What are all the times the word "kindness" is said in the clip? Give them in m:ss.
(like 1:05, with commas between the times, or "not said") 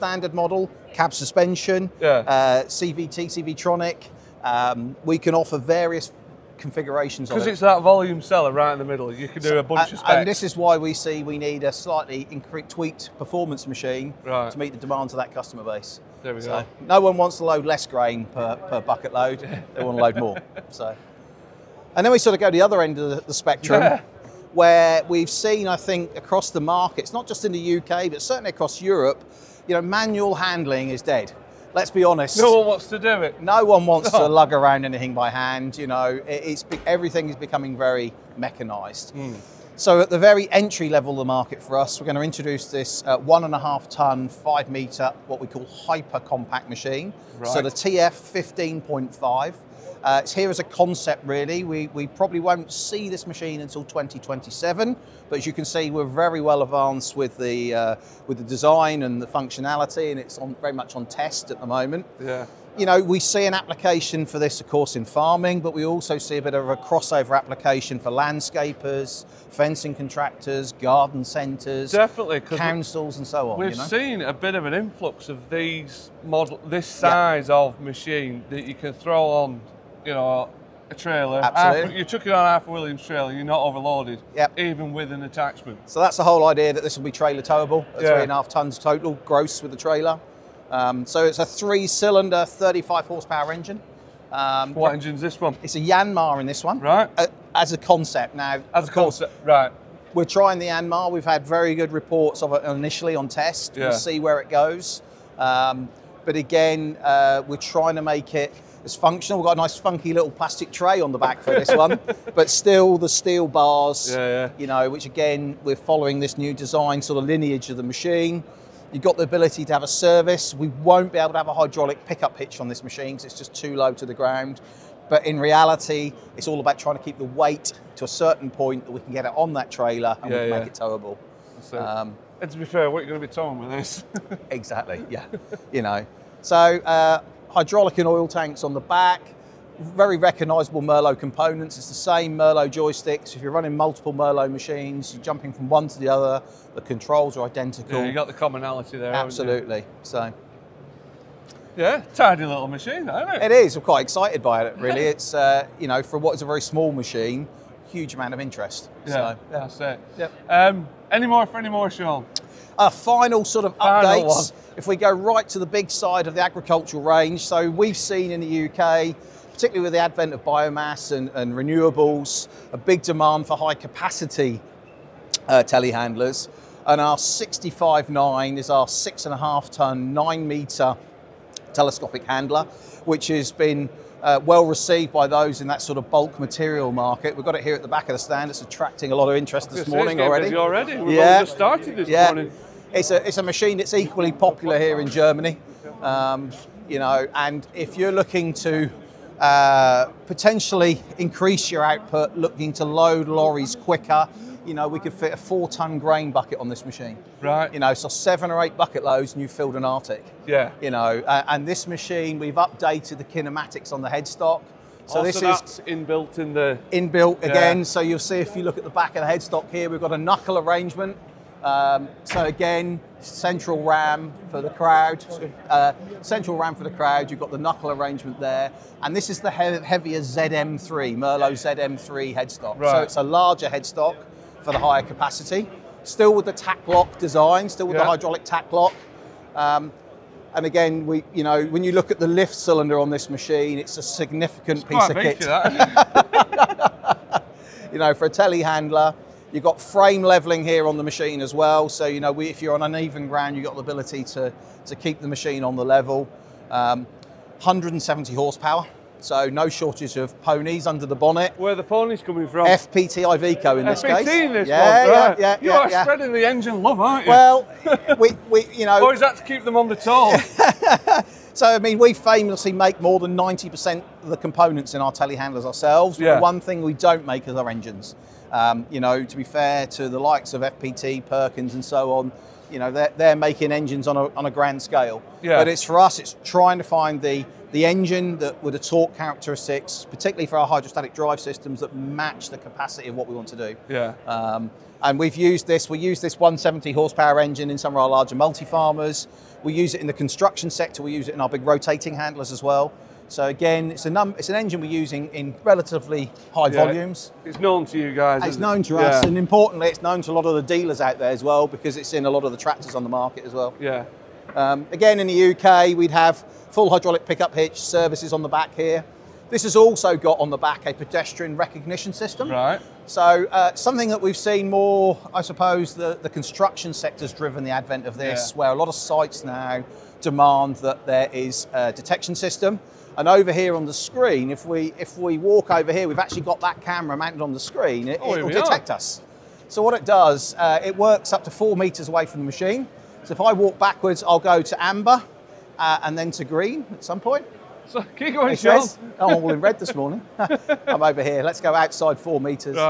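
not said.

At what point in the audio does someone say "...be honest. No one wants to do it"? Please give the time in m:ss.
0:31.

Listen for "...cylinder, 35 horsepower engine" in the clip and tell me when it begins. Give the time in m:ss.
1:31.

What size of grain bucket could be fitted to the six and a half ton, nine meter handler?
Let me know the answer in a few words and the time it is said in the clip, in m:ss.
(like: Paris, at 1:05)
4 ton, at 3:25.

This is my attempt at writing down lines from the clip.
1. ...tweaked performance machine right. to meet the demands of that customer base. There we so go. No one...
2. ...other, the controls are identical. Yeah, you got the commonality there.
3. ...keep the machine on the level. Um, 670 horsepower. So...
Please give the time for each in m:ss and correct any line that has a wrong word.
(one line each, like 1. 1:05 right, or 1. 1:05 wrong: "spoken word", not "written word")
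1. 0:12 right
2. 2:26 right
3. 4:14 wrong: "170", not "670".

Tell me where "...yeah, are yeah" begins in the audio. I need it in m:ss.
4:25.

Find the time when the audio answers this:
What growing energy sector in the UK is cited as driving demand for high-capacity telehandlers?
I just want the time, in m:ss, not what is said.
2:50.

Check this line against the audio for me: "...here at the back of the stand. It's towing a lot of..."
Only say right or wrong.
wrong.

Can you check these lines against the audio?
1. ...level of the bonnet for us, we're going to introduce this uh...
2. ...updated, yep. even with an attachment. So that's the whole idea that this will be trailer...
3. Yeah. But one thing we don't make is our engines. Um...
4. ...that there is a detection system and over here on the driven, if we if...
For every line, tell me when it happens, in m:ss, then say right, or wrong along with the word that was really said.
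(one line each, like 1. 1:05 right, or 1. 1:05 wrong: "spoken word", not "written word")
1. 0:40 wrong: "market", not "bonnet"
2. 1:23 wrong: "overloaded", not "updated"
3. 4:36 right
4. 5:30 wrong: "screen", not "driven".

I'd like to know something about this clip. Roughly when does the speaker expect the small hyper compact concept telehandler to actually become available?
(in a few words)
2027.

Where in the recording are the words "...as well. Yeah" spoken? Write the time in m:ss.
5:13.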